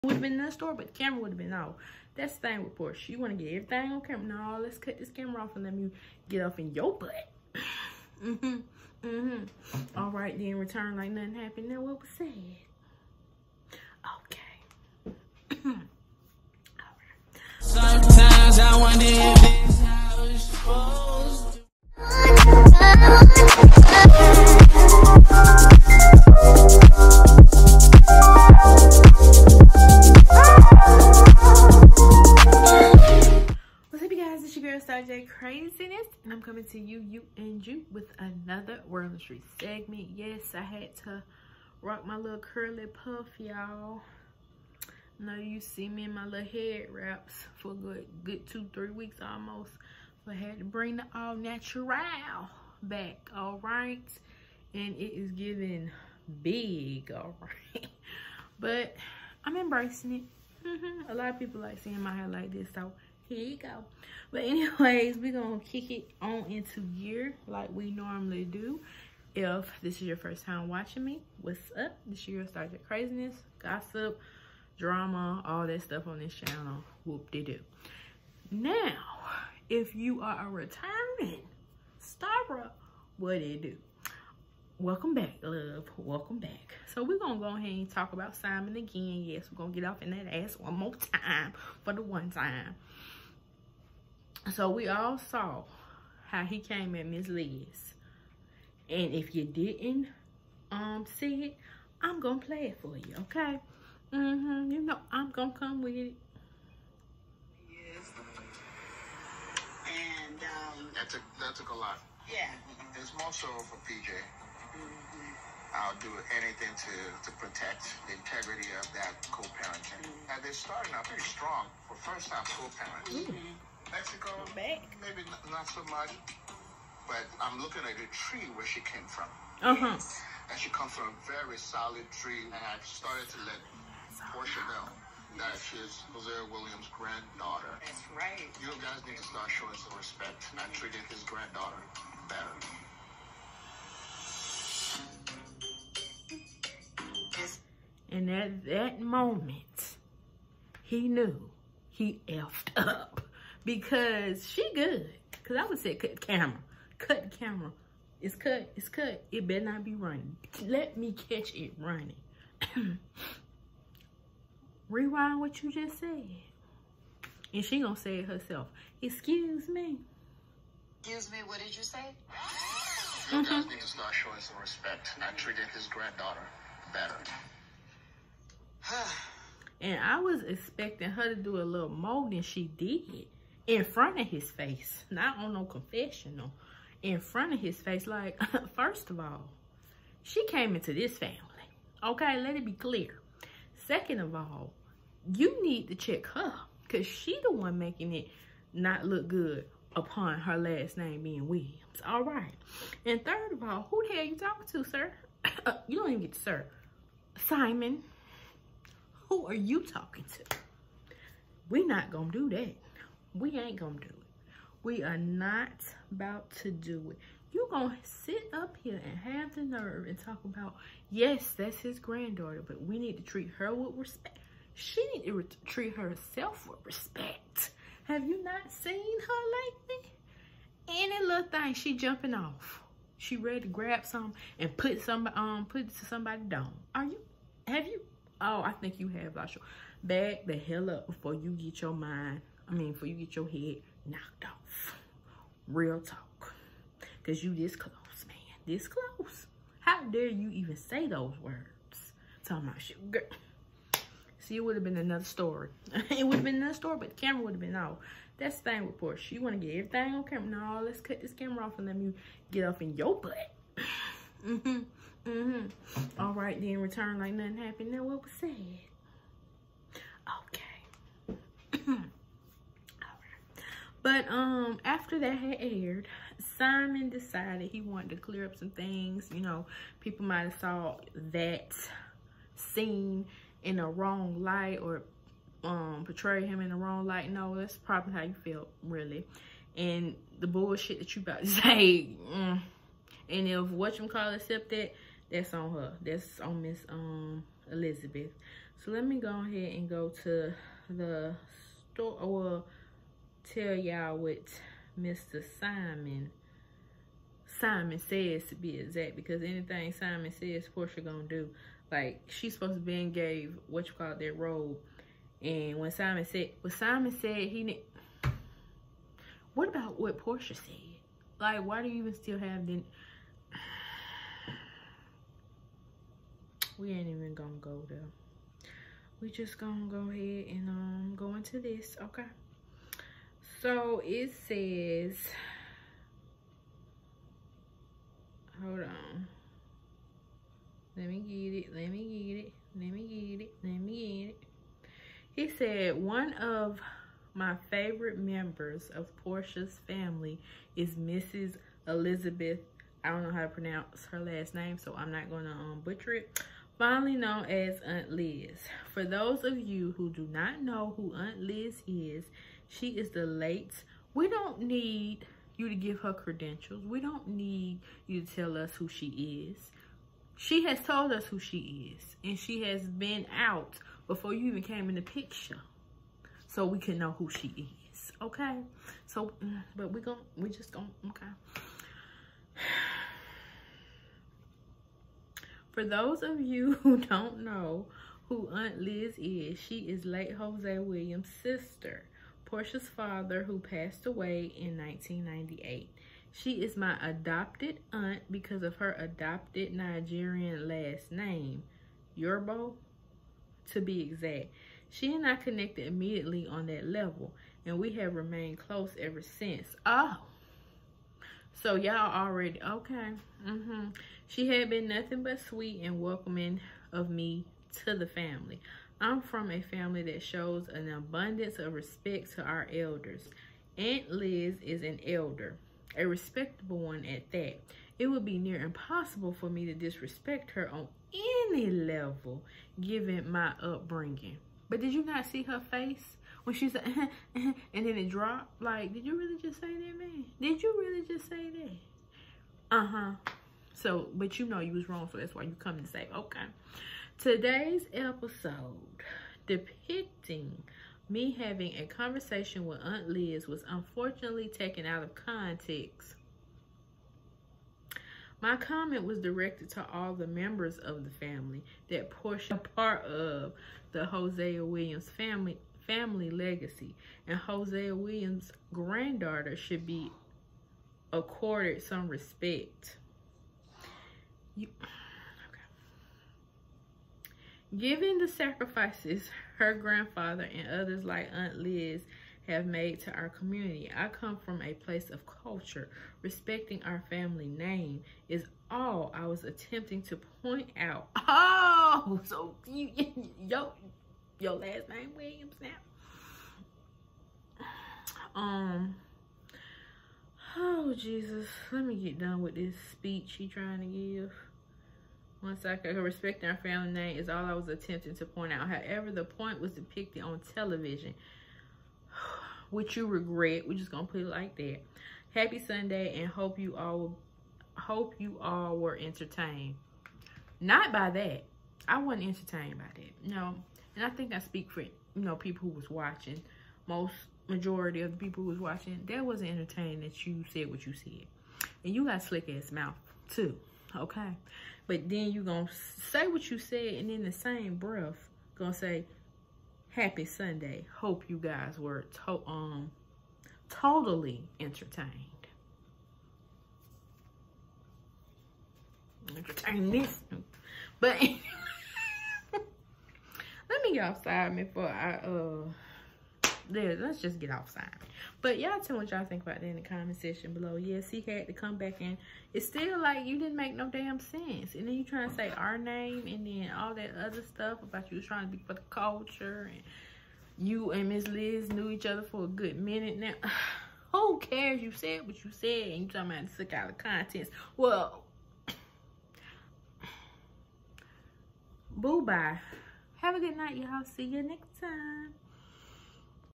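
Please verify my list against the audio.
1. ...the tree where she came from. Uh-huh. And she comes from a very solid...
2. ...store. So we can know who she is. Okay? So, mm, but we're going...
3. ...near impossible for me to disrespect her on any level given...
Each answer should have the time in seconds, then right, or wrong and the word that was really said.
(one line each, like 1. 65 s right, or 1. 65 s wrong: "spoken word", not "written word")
1. 127 s right
2. 375 s wrong: "picture", not "store"
3. 428 s right.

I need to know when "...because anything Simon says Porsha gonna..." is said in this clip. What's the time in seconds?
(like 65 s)
309 s.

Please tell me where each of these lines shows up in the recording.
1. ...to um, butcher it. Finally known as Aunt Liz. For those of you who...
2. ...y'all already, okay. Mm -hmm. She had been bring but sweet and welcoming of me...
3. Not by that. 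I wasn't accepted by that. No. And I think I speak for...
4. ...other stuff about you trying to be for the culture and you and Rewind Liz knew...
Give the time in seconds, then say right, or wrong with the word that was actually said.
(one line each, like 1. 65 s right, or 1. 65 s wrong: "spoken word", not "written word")
1. 355 s right
2. 411 s wrong: "nothing", not "bring"
3. 520 s wrong: "entertained", not "accepted"
4. 567 s wrong: "Miss", not "Rewind".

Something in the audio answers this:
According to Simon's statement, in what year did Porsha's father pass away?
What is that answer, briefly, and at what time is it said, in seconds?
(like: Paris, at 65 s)
1998, at 394 s.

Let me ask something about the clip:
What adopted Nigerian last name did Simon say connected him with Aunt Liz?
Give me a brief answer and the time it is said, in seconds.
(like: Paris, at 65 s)
Yorbo, at 402 s.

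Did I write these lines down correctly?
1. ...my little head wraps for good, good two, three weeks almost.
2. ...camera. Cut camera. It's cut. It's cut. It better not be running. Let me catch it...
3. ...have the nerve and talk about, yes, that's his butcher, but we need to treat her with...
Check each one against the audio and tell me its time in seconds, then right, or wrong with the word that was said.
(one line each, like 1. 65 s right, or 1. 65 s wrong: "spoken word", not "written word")
1. 46 s right
2. 156 s right
3. 219 s wrong: "granddaughter", not "butcher".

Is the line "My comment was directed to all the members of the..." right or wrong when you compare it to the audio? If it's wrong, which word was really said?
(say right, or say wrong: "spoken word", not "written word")
right.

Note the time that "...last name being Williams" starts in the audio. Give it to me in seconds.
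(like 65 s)
200 s.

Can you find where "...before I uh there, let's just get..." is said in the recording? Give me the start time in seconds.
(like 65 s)
554 s.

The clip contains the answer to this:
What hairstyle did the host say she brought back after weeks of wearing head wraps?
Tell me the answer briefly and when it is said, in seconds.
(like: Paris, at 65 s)
curly puff, at 42 s.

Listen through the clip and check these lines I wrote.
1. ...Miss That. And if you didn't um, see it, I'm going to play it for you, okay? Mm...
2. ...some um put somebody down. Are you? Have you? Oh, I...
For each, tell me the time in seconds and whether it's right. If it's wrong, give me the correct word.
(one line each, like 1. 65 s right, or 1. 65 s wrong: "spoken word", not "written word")
1. 97 s wrong: "Liz", not "That"
2. 235 s right.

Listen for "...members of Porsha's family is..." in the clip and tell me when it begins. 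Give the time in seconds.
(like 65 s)
348 s.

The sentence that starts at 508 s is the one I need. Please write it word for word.
However, the point was depicted on television.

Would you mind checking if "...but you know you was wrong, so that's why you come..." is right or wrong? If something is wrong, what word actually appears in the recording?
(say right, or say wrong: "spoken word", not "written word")
right.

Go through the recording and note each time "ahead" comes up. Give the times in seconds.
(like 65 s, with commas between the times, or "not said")
87 s, 299 s, 330 s.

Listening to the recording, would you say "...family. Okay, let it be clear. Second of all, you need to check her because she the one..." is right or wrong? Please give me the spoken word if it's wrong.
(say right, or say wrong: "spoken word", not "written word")
right.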